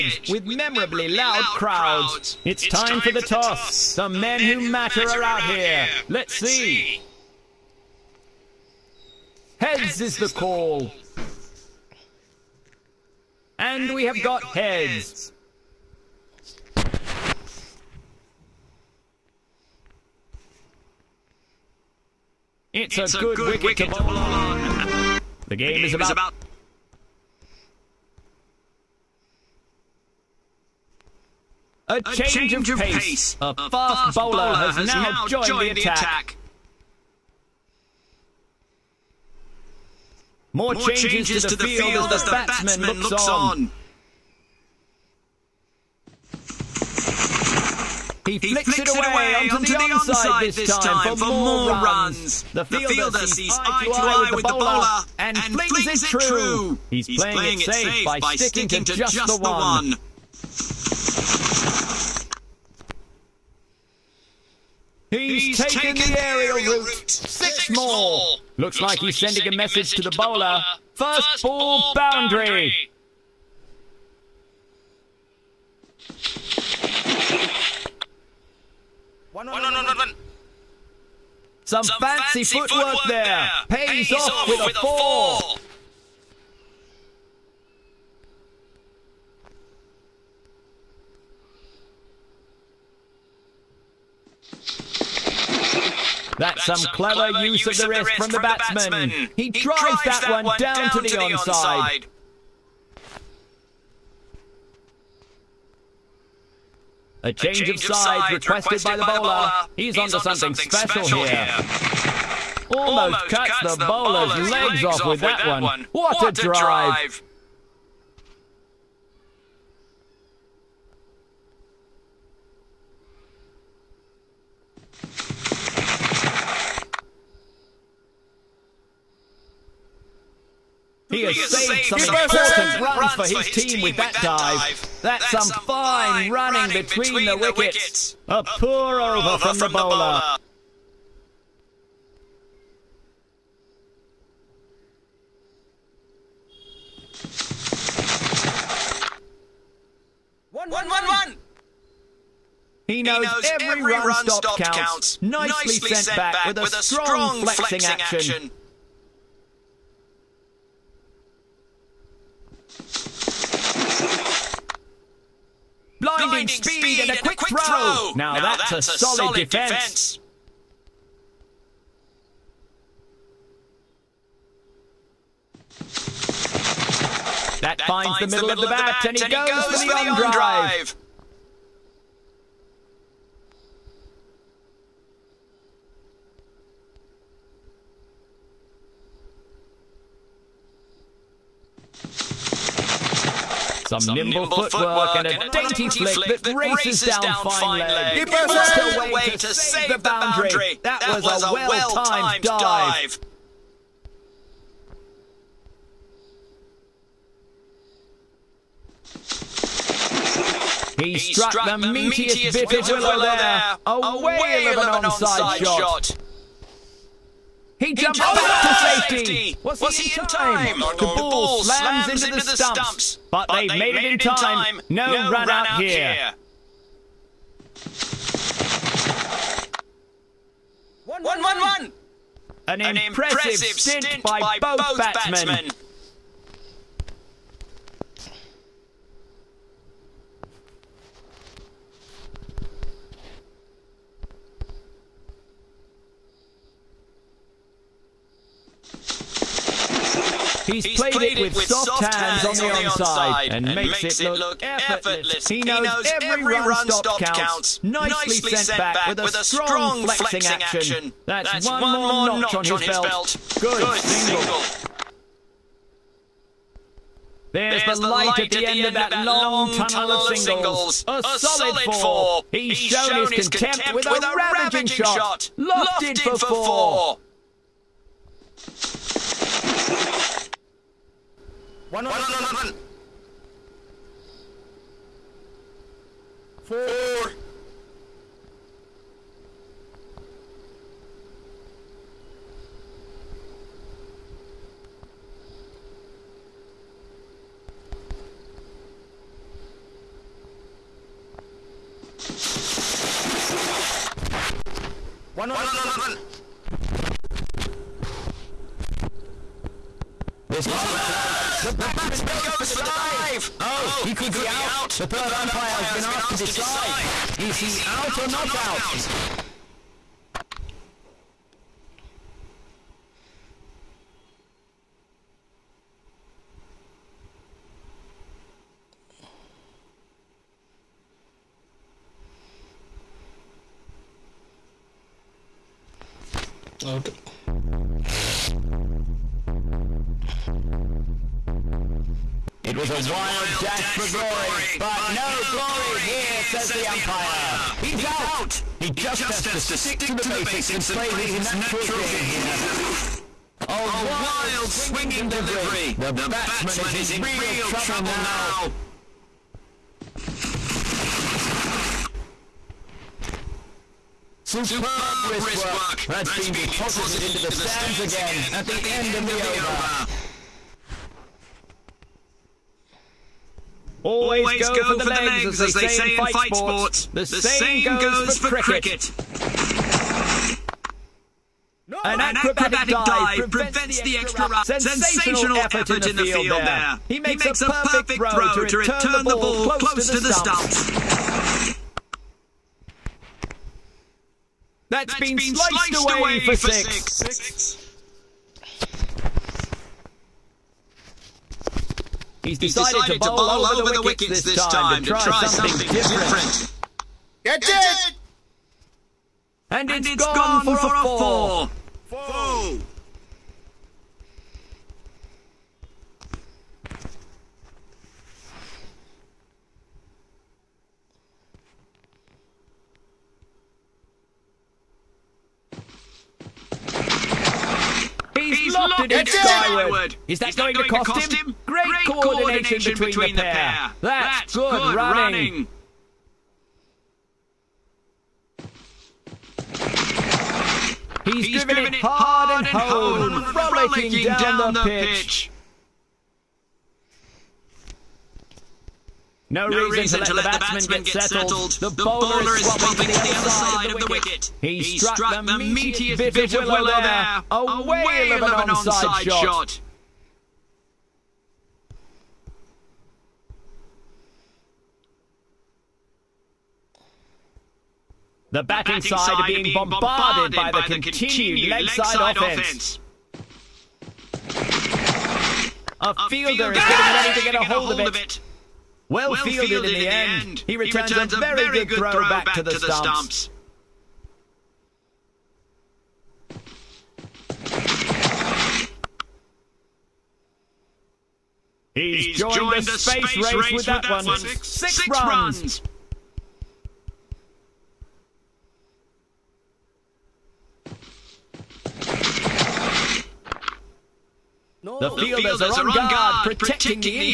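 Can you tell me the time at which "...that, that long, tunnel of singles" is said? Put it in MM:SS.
04:28.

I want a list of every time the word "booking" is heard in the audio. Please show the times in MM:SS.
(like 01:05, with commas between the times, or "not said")
not said.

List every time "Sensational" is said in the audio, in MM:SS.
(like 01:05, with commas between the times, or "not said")
06:24.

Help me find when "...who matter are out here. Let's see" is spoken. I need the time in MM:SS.
00:04.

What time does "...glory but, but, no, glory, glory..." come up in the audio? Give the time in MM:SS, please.
05:44.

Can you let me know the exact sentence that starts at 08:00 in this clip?
He returns a very good throw back to the stumps.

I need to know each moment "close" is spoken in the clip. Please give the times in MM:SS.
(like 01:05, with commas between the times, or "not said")
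05:10, 06:29.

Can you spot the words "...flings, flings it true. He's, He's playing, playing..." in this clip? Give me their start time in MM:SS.
00:55.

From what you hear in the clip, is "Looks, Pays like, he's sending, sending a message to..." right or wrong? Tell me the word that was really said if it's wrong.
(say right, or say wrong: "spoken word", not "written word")
wrong: "Looks", not "Pays".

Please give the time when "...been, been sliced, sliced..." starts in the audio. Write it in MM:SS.
06:35.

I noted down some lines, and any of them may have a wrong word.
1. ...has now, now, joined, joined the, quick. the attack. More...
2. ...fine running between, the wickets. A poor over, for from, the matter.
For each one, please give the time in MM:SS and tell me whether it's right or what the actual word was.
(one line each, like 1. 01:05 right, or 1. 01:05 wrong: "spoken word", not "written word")
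1. 00:34 wrong: "attack", not "quick"
2. 02:15 wrong: "bowler", not "matter".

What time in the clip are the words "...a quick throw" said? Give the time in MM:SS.
02:47.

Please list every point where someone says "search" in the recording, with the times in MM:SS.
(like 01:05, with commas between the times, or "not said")
not said.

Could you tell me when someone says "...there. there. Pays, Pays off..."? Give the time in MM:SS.
01:23.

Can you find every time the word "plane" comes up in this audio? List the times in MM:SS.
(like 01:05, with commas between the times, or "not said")
not said.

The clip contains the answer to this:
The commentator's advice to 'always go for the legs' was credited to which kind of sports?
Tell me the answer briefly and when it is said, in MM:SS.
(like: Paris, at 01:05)
fight sports, at 06:16.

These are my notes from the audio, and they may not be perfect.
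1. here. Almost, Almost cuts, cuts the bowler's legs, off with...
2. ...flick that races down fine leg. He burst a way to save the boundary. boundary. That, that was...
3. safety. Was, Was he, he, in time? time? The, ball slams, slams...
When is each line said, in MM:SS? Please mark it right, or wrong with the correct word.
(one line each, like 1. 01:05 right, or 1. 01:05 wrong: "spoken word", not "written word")
1. 01:51 right
2. 03:16 right
3. 03:39 right.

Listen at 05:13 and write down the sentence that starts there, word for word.
Oh, oh, he could, he could be, out.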